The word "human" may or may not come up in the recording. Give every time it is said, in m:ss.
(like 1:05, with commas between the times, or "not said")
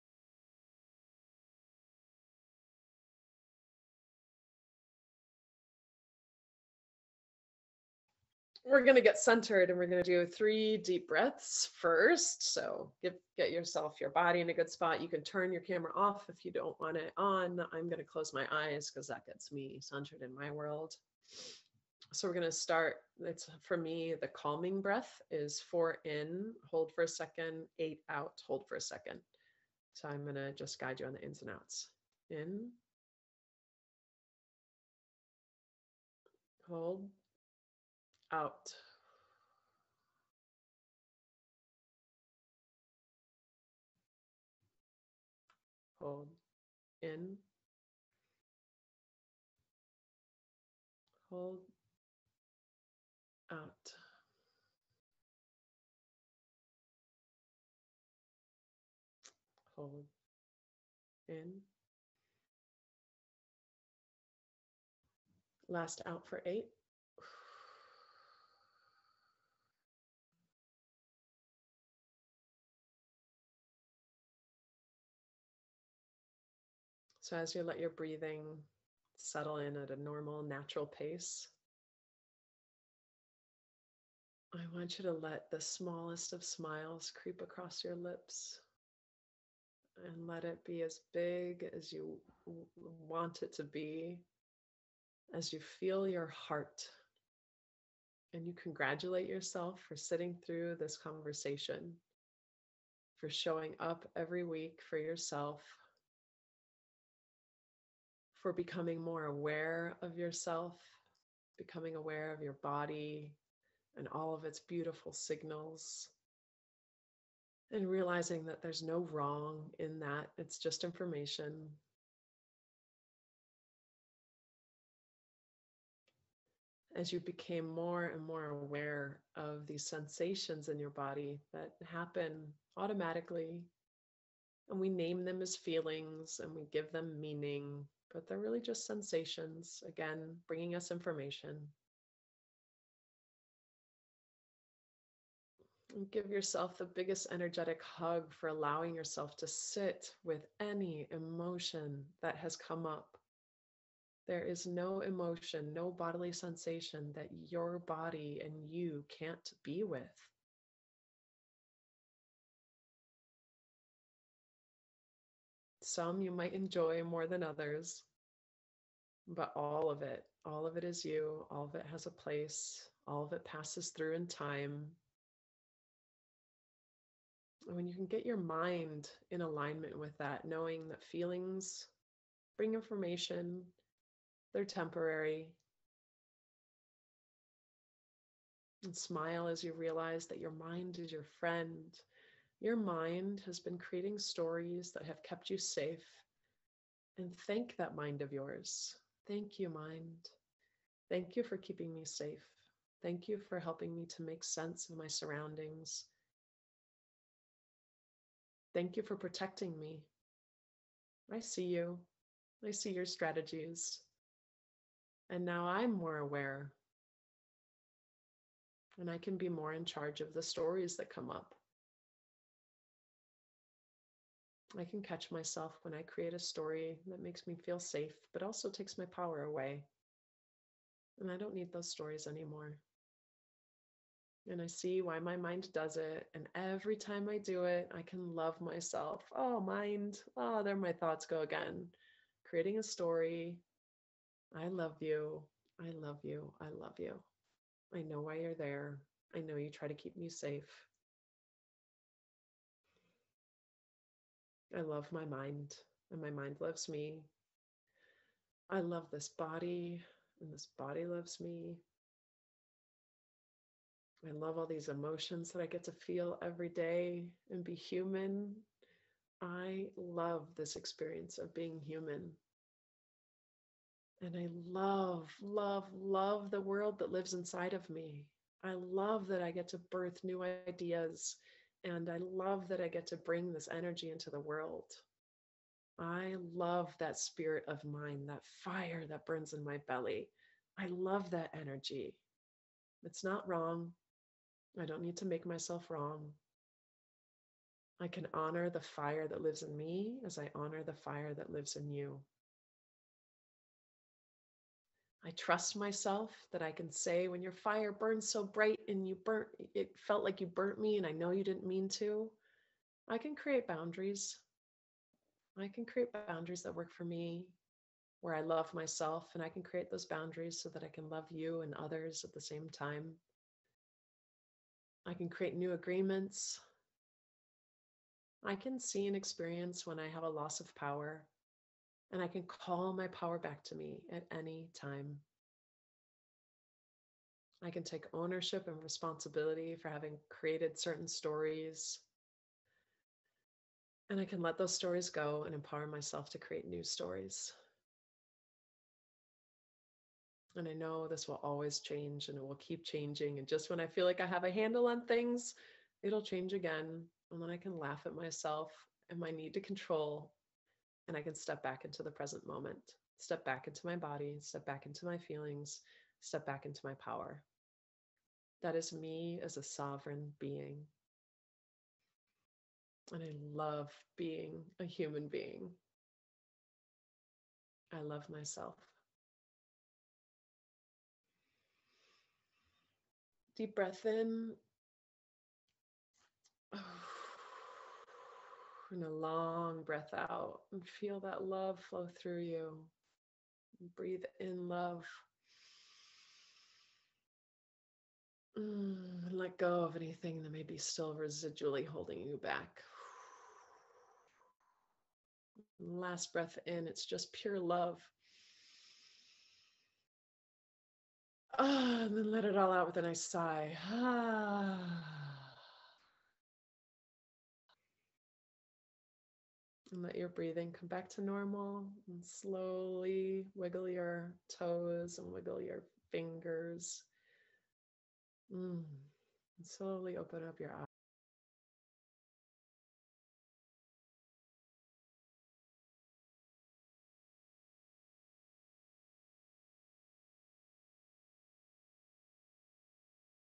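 4:27, 4:31, 6:14.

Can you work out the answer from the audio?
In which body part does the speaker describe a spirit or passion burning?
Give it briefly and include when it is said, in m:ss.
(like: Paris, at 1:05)
belly, at 4:49.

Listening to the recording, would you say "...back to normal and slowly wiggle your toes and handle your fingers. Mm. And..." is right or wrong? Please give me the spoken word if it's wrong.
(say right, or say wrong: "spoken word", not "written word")
wrong: "wiggle", not "handle".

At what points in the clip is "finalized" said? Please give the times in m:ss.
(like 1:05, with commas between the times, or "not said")
not said.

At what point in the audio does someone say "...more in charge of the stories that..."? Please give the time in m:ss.
3:39.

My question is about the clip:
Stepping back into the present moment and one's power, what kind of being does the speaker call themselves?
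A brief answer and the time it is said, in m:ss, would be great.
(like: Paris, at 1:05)
sovereign being, at 6:09.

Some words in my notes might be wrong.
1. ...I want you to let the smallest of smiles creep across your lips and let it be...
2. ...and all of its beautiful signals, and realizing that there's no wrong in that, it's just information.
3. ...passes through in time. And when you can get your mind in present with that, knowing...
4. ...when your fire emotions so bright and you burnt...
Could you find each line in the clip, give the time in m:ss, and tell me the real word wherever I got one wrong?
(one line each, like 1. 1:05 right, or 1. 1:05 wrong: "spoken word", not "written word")
1. 1:24 right
2. 1:53 right
3. 2:53 wrong: "alignment", not "present"
4. 5:07 wrong: "burns", not "emotions".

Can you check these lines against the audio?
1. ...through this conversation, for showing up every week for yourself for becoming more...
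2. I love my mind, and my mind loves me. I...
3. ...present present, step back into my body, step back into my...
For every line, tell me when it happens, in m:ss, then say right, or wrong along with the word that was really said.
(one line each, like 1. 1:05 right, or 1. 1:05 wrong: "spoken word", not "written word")
1. 1:40 right
2. 4:14 right
3. 6:02 wrong: "moment", not "present".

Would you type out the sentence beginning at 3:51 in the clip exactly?
And I don't need those stories anymore.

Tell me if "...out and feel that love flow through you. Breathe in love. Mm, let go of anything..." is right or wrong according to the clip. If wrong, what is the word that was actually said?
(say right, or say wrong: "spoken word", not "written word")
right.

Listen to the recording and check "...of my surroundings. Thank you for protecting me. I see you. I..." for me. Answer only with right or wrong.
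right.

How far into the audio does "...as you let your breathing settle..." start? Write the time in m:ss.
1:17.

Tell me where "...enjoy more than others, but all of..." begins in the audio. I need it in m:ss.
2:46.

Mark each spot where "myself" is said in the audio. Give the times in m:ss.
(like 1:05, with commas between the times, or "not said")
3:45, 3:58, 4:55, 5:05, 5:18, 5:45, 5:58, 6:18.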